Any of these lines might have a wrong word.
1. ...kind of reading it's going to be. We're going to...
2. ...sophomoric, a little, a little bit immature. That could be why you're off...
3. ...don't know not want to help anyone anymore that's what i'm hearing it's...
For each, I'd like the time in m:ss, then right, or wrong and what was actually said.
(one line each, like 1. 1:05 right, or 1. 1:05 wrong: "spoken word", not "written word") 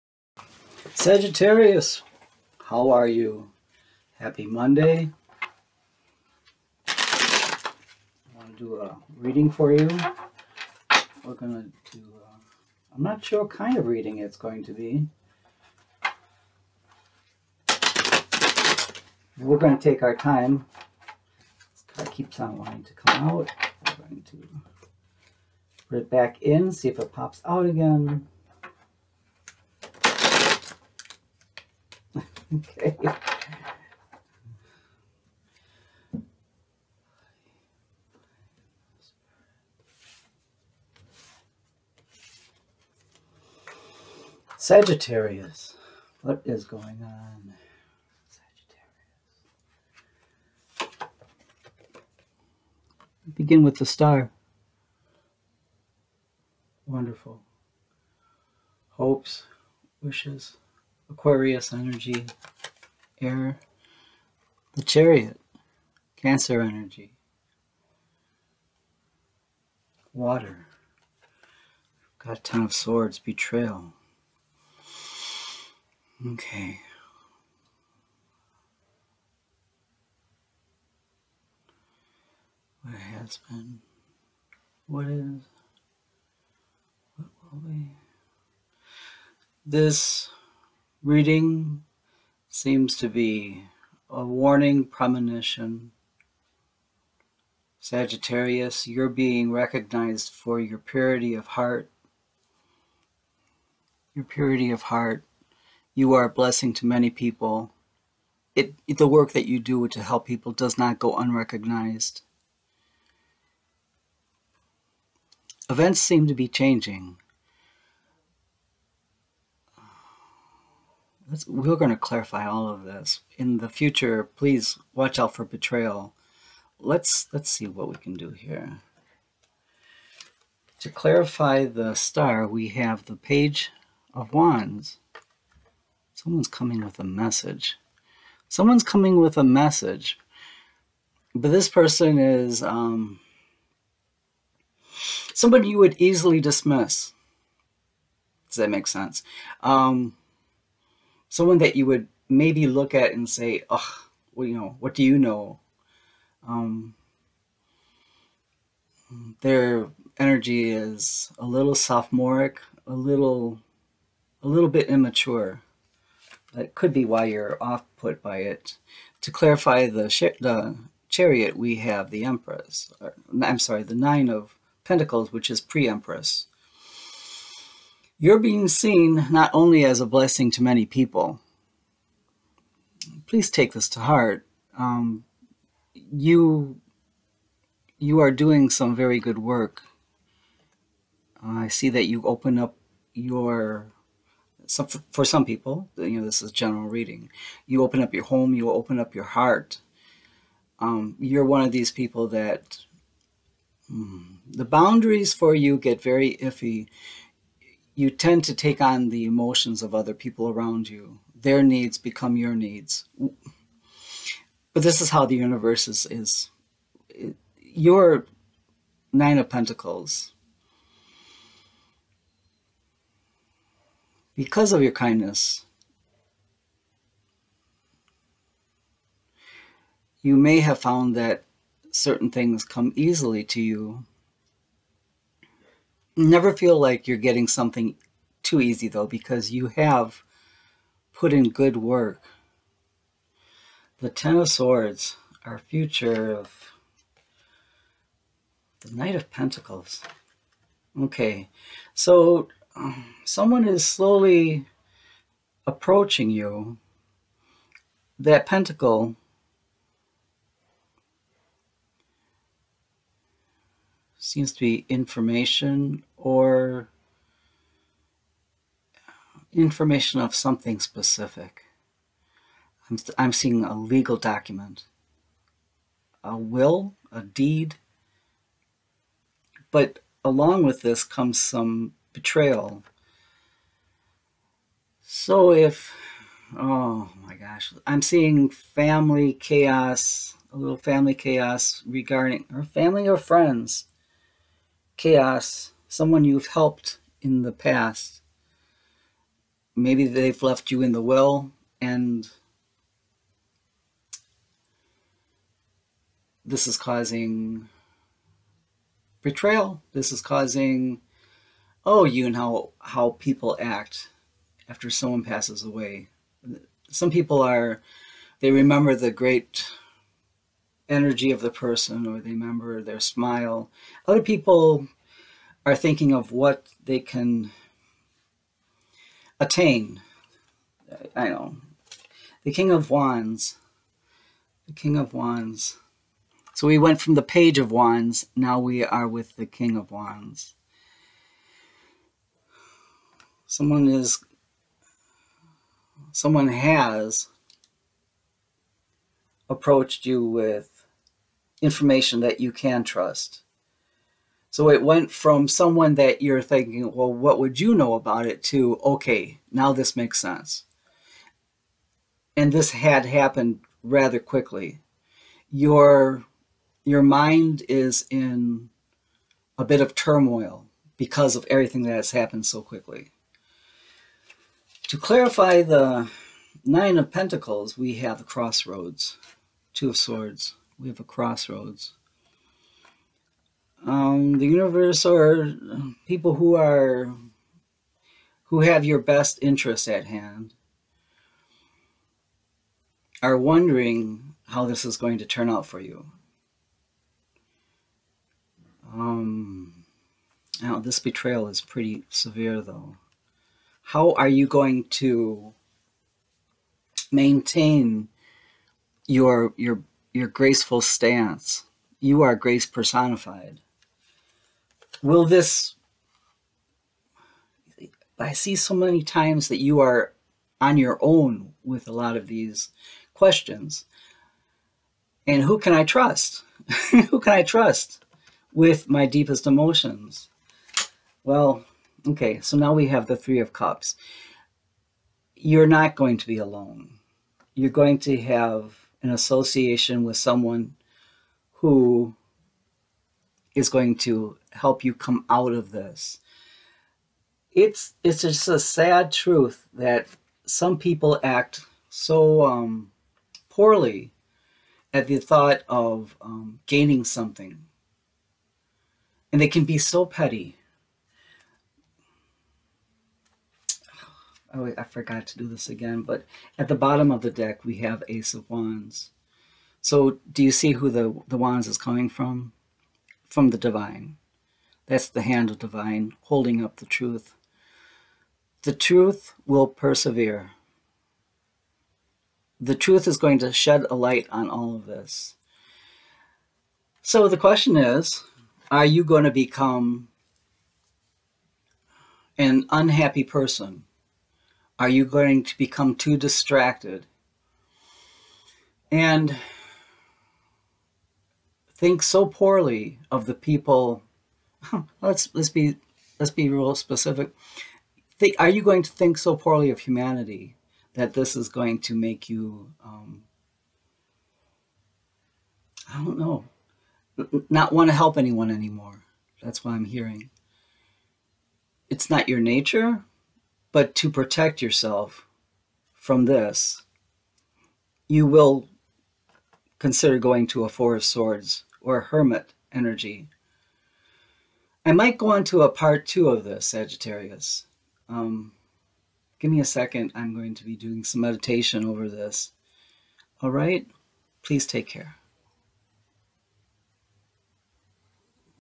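1. 0:13 right
2. 2:41 right
3. 8:36 right.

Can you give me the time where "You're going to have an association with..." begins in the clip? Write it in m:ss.
7:17.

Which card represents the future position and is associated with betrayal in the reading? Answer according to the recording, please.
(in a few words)
Ten of Swords.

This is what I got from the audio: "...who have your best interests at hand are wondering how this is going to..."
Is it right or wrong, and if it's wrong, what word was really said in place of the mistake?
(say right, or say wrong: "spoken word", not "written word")
right.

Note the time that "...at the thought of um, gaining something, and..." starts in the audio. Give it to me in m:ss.
7:34.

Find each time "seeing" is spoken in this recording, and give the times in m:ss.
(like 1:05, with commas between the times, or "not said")
4:33, 4:48.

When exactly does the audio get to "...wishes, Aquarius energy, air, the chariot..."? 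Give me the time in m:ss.
1:00.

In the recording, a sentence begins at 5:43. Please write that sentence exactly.
Someone is, someone has approached you with information that you can trust.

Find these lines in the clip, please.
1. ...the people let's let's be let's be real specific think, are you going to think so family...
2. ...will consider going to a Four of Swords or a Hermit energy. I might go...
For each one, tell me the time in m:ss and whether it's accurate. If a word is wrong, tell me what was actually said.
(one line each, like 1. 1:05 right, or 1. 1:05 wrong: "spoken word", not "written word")
1. 8:23 wrong: "poorly", not "family"
2. 8:48 right.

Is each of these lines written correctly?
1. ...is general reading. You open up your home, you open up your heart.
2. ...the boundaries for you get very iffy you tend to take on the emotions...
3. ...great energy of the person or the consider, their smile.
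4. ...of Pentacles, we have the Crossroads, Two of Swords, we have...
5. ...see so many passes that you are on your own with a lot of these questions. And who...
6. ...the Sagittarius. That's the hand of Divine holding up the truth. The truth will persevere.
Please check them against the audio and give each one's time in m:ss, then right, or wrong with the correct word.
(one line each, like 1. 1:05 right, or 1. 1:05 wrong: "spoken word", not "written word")
1. 3:16 right
2. 3:24 right
3. 5:19 wrong: "member", not "consider"
4. 6:16 right
5. 6:58 wrong: "times", not "passes"
6. 7:53 wrong: "Divine", not "Sagittarius".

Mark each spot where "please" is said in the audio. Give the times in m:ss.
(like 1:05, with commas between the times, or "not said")
2:04, 3:03, 9:04.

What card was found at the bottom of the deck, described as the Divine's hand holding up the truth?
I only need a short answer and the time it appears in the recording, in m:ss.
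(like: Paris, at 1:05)
Ace of Wands, at 7:48.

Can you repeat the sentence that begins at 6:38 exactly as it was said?
Um, now this betrayal is pretty severe though.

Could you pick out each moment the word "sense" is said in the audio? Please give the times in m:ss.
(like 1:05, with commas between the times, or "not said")
2:28, 6:00.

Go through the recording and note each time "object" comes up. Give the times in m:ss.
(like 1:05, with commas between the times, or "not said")
not said.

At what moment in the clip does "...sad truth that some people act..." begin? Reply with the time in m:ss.
7:28.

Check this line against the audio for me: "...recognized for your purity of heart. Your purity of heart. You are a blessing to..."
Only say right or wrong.
right.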